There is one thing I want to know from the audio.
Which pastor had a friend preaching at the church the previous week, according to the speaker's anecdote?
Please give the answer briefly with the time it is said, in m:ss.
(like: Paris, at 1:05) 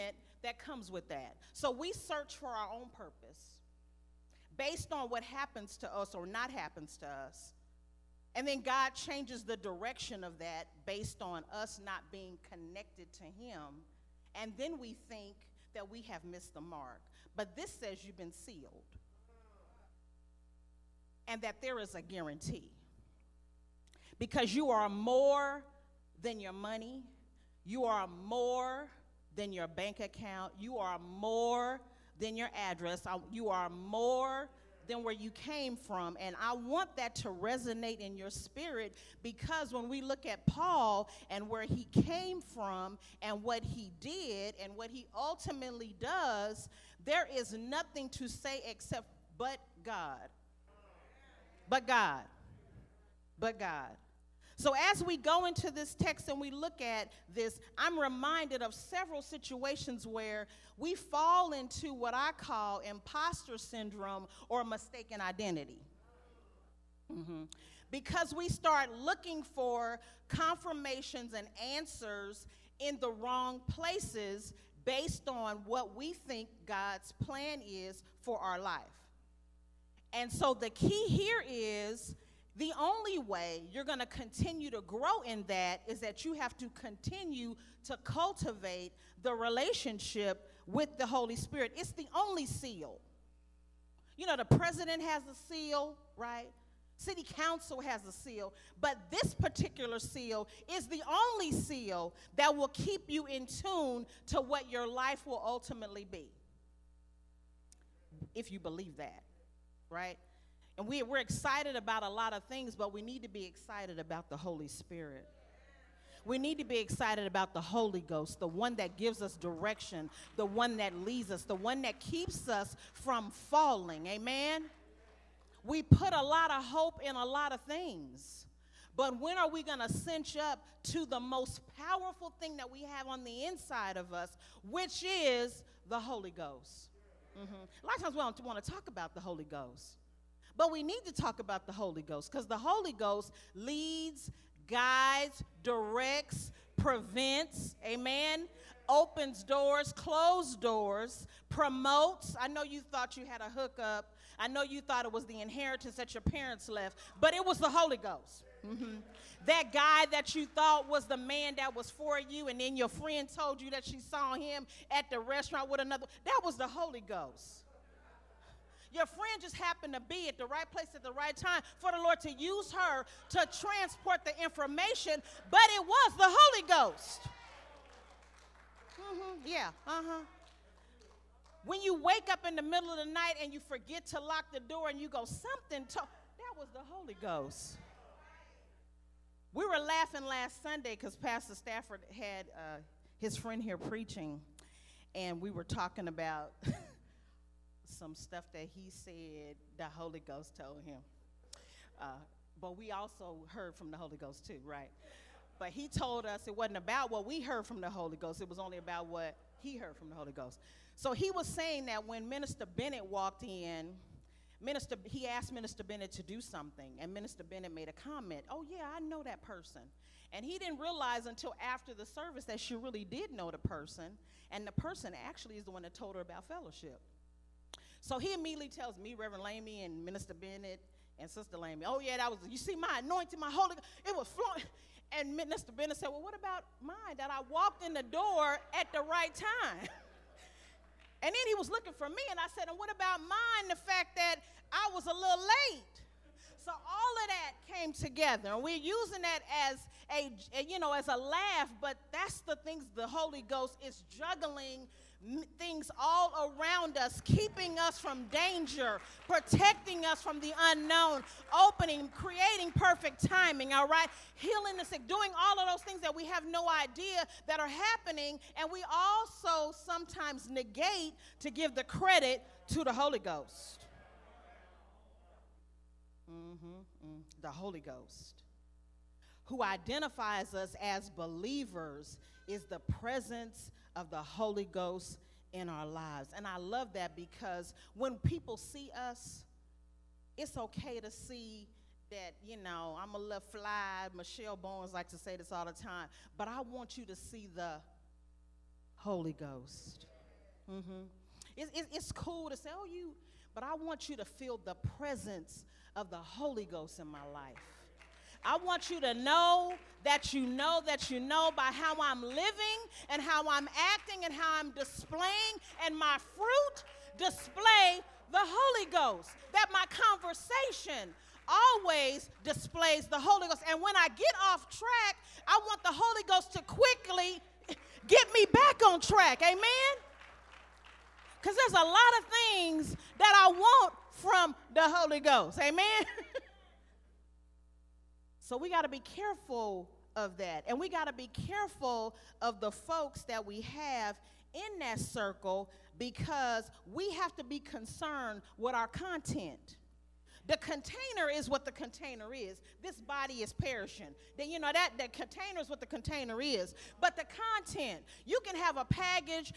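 Pastor Stafford, at 3:11.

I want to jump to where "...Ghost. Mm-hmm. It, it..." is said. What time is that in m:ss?
4:59.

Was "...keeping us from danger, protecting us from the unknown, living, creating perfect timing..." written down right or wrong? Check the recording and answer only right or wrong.
wrong.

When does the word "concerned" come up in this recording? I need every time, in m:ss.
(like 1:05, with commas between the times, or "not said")
5:47.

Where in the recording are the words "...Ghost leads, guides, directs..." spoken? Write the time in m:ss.
2:22.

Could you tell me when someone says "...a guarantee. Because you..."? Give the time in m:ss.
0:21.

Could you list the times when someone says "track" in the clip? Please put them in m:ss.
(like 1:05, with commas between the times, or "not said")
5:24, 5:29.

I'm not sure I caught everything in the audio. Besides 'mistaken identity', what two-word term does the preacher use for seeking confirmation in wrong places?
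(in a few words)
imposter syndrome.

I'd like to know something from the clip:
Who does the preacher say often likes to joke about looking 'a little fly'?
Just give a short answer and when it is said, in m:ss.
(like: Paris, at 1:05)
Michelle Bones, at 4:54.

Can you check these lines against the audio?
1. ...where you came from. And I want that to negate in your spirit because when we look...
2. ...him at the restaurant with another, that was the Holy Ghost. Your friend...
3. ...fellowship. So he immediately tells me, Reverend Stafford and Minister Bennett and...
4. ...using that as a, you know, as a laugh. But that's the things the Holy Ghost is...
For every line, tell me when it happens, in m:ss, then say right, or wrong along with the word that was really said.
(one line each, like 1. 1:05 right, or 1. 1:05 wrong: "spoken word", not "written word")
1. 0:35 wrong: "resonate", not "negate"
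2. 2:44 right
3. 3:46 wrong: "Lamy", not "Stafford"
4. 4:08 right.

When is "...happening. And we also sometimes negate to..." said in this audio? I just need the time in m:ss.
4:27.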